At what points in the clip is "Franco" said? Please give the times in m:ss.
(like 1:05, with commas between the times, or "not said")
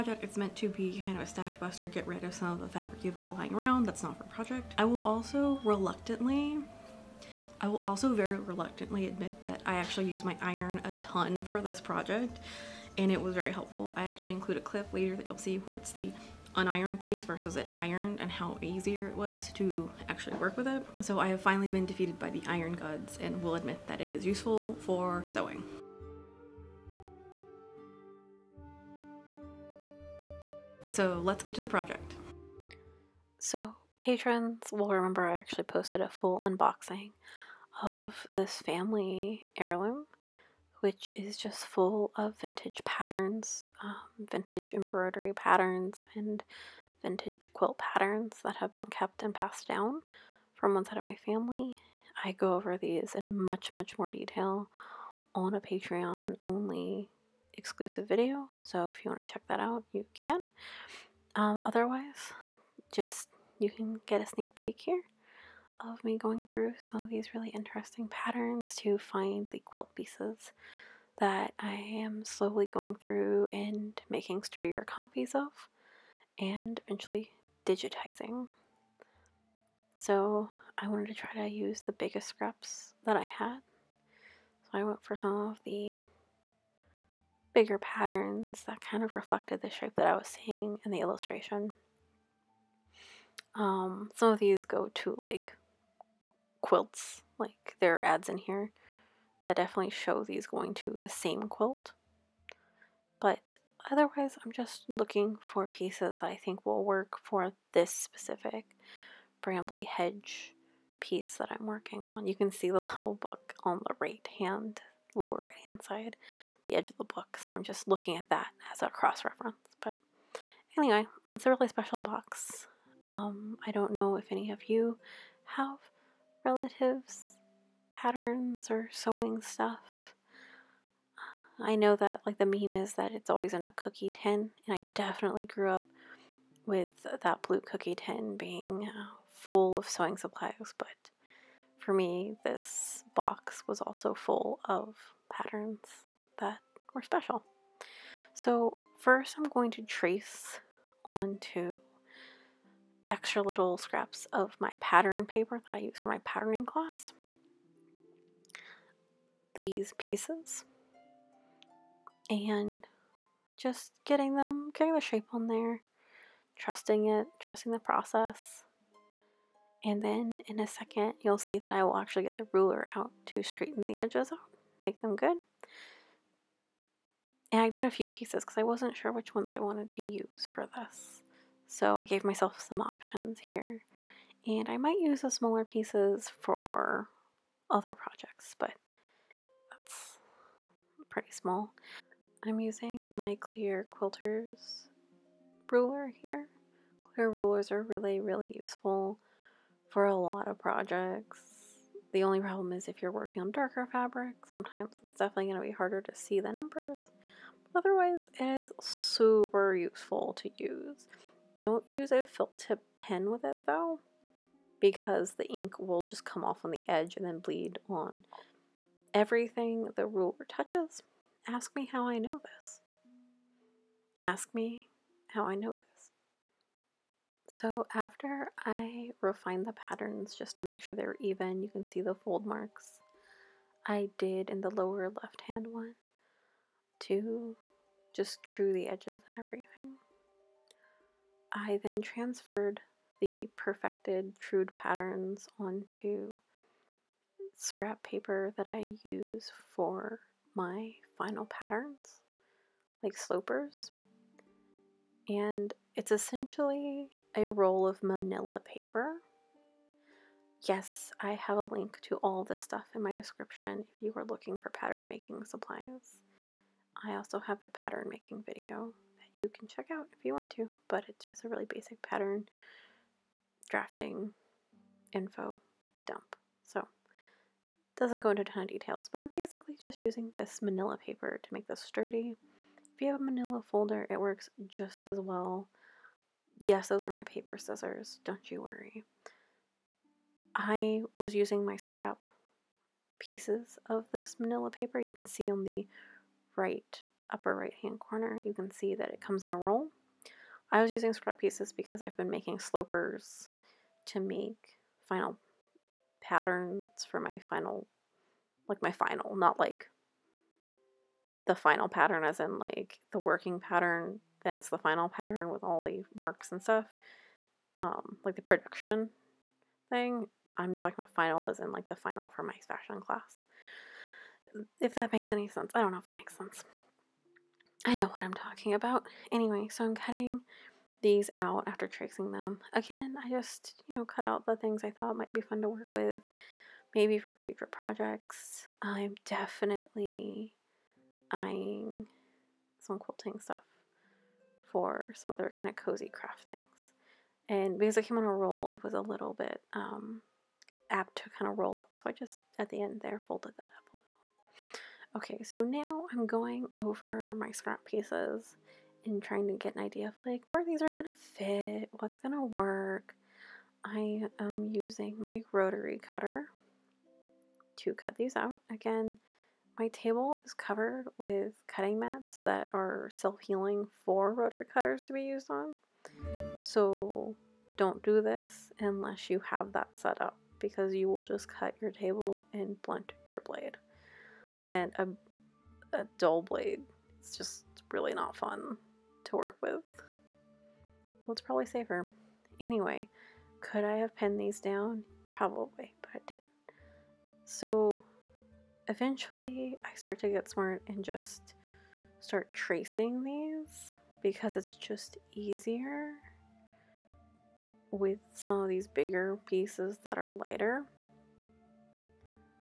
not said.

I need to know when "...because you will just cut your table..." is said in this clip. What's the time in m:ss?
6:20.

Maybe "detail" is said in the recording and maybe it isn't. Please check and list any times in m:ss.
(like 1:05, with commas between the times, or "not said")
0:54, 4:38.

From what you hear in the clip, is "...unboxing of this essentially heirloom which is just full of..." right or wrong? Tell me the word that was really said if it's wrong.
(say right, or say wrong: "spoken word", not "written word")
wrong: "family", not "essentially".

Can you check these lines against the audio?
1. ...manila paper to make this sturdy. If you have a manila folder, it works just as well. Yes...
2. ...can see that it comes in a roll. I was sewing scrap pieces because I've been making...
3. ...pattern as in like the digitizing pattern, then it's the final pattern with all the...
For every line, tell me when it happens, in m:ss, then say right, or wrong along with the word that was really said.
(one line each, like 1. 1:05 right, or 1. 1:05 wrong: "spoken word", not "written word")
1. 4:40 right
2. 4:58 wrong: "using", not "sewing"
3. 5:11 wrong: "working", not "digitizing".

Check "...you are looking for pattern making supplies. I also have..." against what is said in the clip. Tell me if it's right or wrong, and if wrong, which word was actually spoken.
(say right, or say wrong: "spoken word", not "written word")
right.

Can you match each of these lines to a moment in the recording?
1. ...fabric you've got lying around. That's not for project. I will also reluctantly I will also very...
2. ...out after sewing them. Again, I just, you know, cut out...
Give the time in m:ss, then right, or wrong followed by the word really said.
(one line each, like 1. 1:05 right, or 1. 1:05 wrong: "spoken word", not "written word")
1. 0:02 right
2. 5:31 wrong: "tracing", not "sewing".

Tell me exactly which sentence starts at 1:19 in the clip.
So I wanted to try to use the biggest scraps that I had.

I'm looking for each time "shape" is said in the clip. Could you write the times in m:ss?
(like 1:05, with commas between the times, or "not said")
1:29, 2:45.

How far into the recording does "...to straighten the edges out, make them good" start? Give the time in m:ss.
2:53.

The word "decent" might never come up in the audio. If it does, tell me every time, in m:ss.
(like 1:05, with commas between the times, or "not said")
not said.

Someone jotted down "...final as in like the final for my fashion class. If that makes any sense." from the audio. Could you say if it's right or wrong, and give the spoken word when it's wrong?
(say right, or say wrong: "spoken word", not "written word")
right.